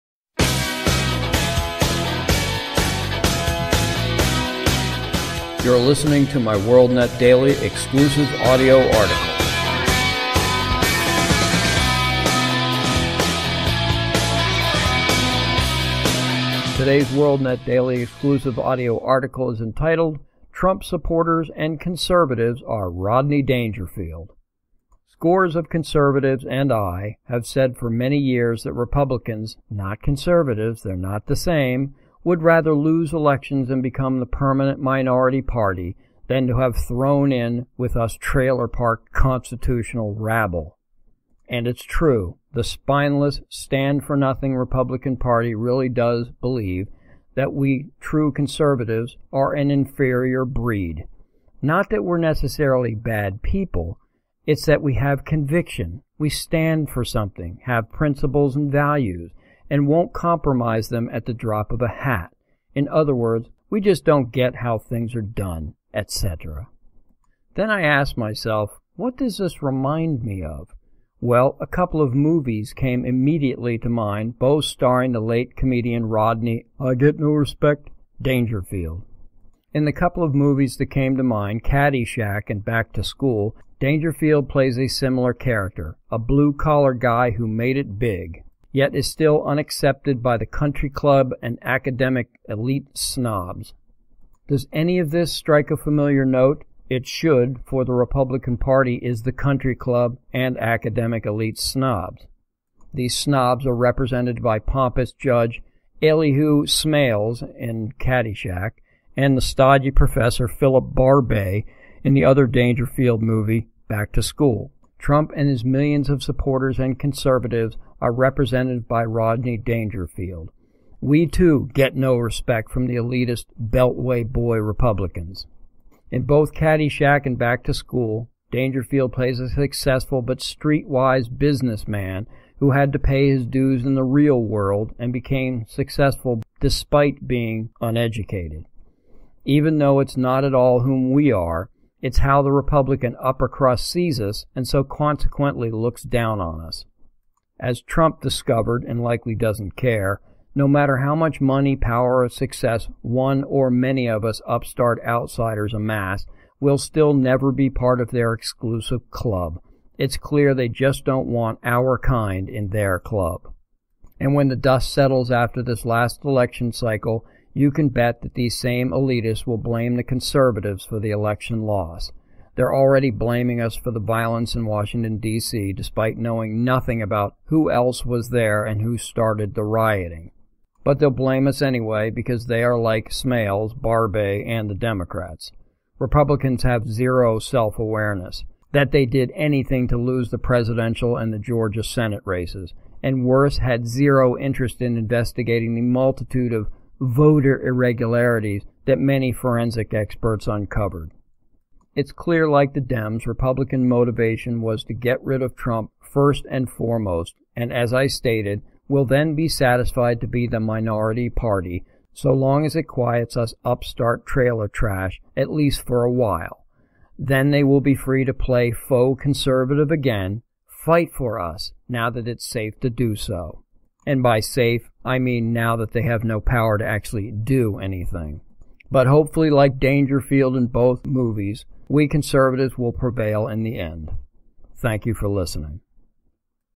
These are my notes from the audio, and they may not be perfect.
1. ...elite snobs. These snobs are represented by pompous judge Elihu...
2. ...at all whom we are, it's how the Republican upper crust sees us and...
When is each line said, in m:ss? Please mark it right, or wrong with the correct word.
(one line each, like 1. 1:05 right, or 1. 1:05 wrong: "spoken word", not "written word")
1. 1:41 right
2. 2:20 right.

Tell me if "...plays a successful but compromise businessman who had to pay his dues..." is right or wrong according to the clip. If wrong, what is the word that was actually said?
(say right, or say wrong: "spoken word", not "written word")
wrong: "streetwise", not "compromise".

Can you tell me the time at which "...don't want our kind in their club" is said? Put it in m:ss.
2:41.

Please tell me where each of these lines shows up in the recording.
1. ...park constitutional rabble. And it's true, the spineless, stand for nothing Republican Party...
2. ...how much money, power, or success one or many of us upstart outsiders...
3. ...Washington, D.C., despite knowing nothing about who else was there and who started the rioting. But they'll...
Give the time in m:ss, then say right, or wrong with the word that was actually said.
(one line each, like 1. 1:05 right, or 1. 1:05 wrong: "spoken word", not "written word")
1. 0:38 right
2. 2:30 right
3. 2:54 right.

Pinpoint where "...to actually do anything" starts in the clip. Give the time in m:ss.
3:46.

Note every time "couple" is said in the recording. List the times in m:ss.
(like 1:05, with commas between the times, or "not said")
1:11, 1:19.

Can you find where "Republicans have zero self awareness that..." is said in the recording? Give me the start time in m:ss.
3:05.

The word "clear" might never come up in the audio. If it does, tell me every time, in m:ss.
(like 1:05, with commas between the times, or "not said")
2:40, 3:22.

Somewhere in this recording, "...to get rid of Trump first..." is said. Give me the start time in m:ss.
3:24.